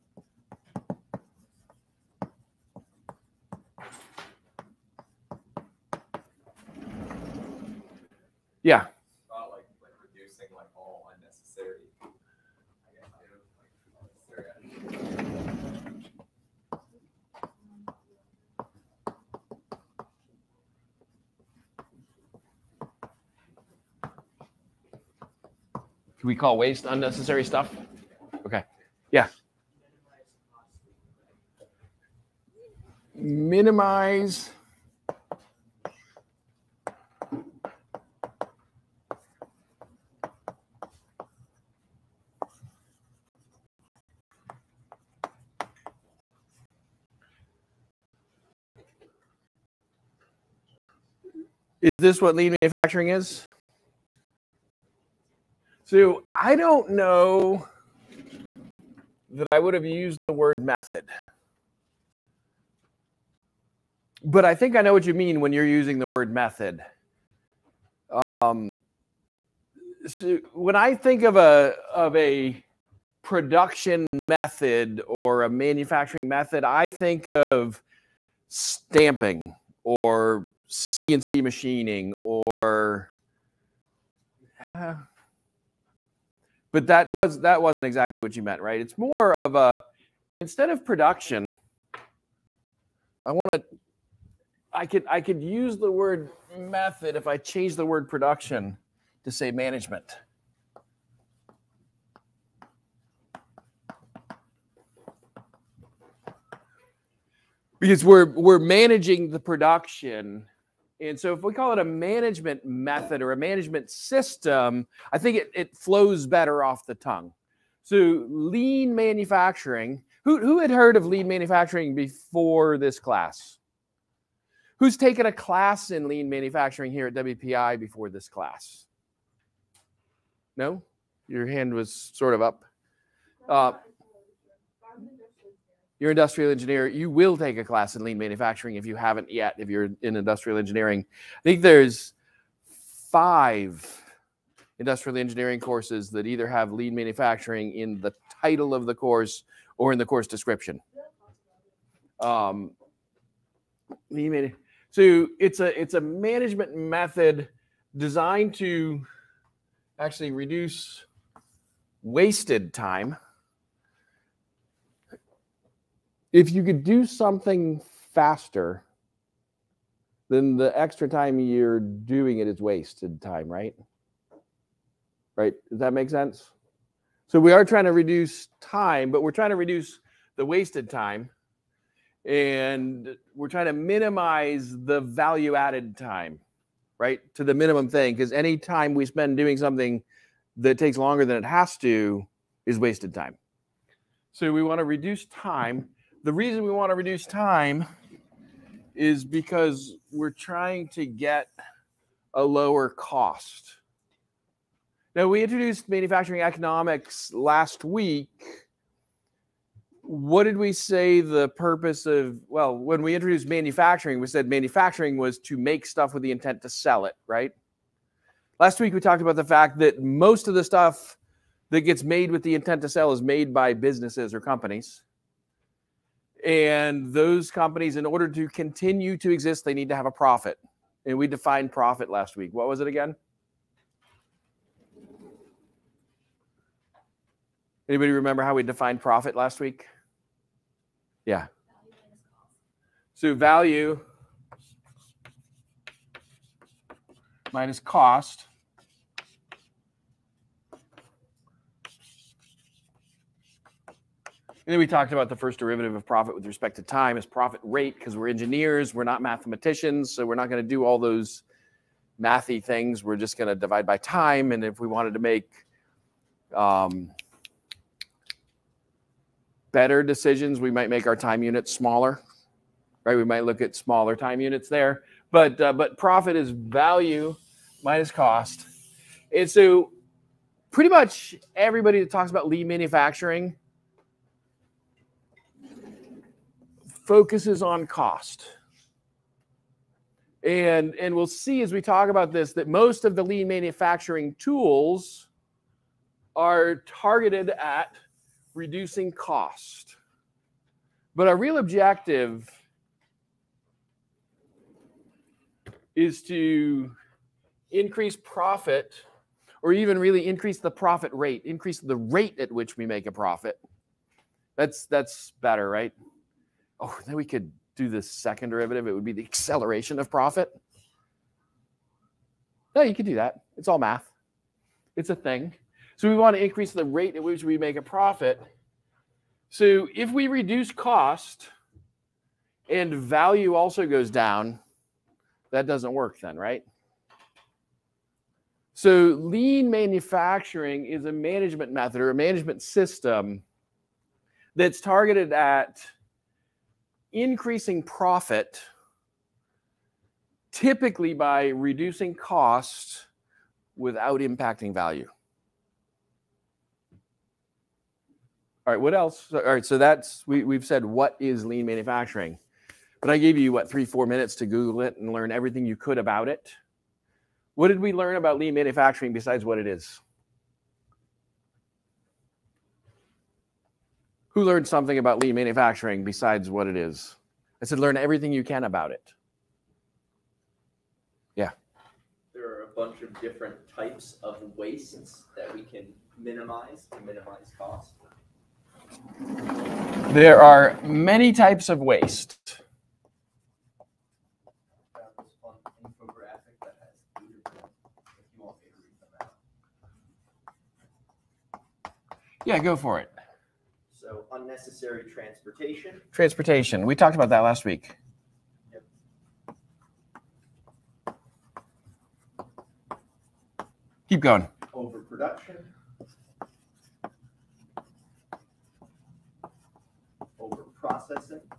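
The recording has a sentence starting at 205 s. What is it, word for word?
Now, we introduced manufacturing economics last week.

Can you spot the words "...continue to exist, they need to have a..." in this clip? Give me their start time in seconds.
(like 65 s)
228 s.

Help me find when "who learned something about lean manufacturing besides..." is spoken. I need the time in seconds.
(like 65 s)
374 s.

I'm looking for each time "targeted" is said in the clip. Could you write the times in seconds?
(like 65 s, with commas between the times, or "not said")
296 s, 344 s.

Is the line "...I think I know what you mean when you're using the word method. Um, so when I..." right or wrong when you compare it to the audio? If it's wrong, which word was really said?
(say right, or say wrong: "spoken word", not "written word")
right.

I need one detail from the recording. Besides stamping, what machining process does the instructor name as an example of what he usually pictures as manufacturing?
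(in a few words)
CNC machining.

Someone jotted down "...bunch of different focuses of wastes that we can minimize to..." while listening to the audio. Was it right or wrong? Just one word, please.
wrong.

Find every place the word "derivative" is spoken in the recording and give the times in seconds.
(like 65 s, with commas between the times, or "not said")
255 s, 318 s.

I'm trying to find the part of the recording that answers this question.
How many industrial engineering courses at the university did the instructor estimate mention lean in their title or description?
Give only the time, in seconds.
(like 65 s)
143 s.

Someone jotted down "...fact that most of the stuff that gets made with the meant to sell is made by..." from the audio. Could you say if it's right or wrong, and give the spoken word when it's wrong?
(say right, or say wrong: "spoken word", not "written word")
wrong: "intent", not "meant".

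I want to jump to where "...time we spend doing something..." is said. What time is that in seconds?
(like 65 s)
188 s.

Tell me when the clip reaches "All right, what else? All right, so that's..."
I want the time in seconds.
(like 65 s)
358 s.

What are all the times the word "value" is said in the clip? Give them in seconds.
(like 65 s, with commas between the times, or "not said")
184 s, 243 s, 276 s, 332 s, 354 s.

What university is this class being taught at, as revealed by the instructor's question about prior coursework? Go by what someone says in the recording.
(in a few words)
WPI.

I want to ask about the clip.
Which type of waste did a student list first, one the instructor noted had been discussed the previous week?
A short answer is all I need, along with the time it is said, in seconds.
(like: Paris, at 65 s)
unnecessary transportation, at 404 s.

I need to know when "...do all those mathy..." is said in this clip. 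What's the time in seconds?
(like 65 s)
260 s.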